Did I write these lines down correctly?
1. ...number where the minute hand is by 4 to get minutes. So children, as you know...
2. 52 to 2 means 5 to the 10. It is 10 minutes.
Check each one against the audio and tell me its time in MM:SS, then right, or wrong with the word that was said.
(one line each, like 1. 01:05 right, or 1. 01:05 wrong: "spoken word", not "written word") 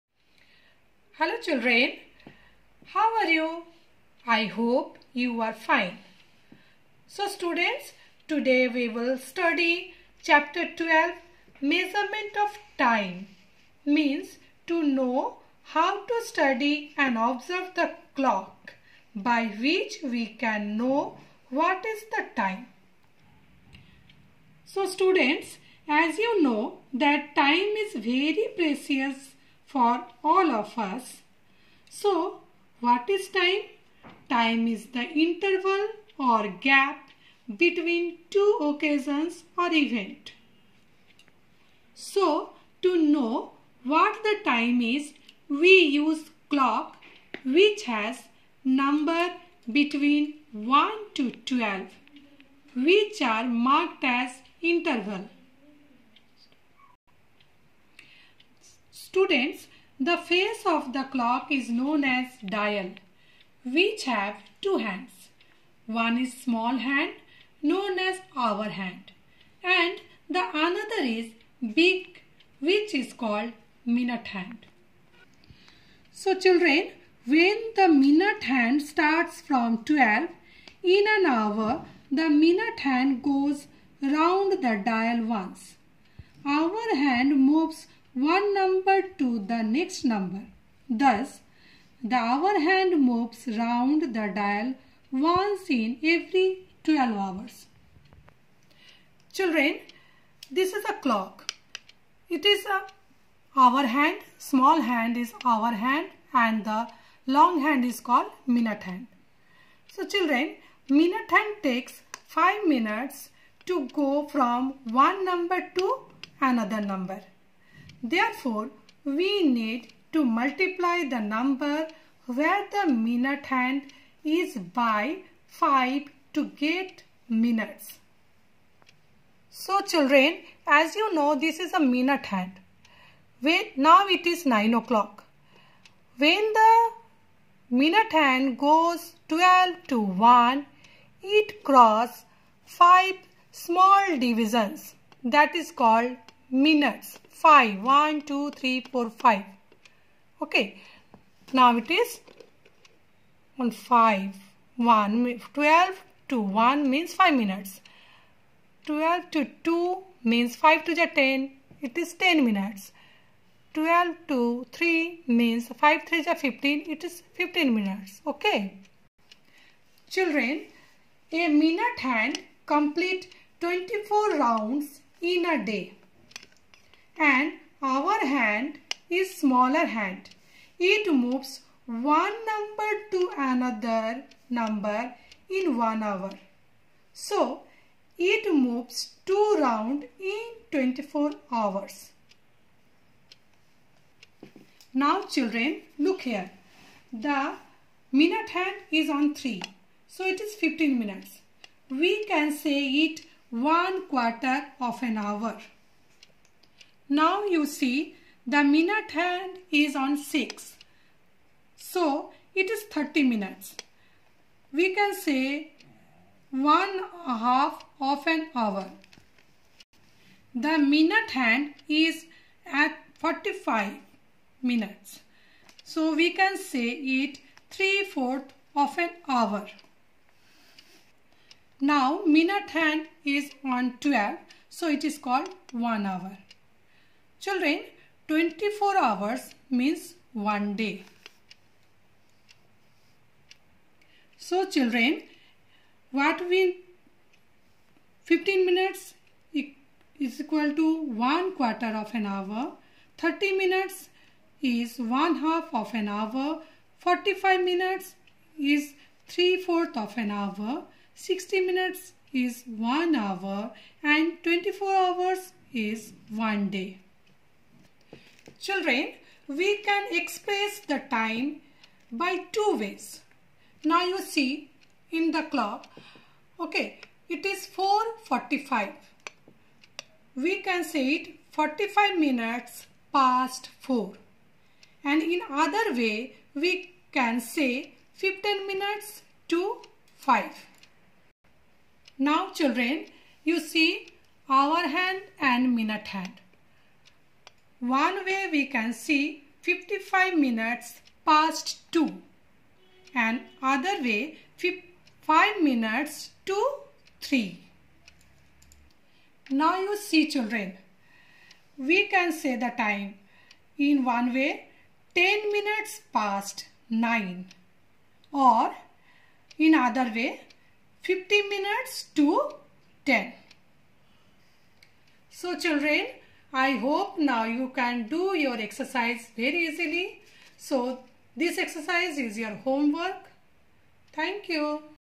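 1. 02:01 wrong: "5", not "4"
2. 02:38 wrong: "12", not "52".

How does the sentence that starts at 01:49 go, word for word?
So children, minute hand takes 5 minutes to go from one number to another number.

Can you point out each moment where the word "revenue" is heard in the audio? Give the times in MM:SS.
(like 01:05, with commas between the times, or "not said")
not said.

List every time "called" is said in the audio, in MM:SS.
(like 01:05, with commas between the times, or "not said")
01:13, 01:48, 02:25, 03:55.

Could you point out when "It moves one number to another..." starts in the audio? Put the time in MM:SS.
03:00.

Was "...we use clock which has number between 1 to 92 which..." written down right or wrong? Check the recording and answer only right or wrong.
wrong.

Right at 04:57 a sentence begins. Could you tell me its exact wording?
One way we can see 55 minutes past 2 and other way 5 minutes to 3.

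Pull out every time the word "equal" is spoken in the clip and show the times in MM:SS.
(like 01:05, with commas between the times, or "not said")
04:10.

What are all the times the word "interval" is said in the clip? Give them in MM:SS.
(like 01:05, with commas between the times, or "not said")
00:35, 00:54.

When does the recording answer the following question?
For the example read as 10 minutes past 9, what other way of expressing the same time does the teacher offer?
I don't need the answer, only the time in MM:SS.
05:21.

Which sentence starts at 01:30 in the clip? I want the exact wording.
Thus, the hour hand moves round the dial once in every 12 hours.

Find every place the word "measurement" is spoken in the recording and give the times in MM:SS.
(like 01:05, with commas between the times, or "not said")
00:11.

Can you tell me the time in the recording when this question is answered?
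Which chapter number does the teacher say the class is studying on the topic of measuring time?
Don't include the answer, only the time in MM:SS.
00:10.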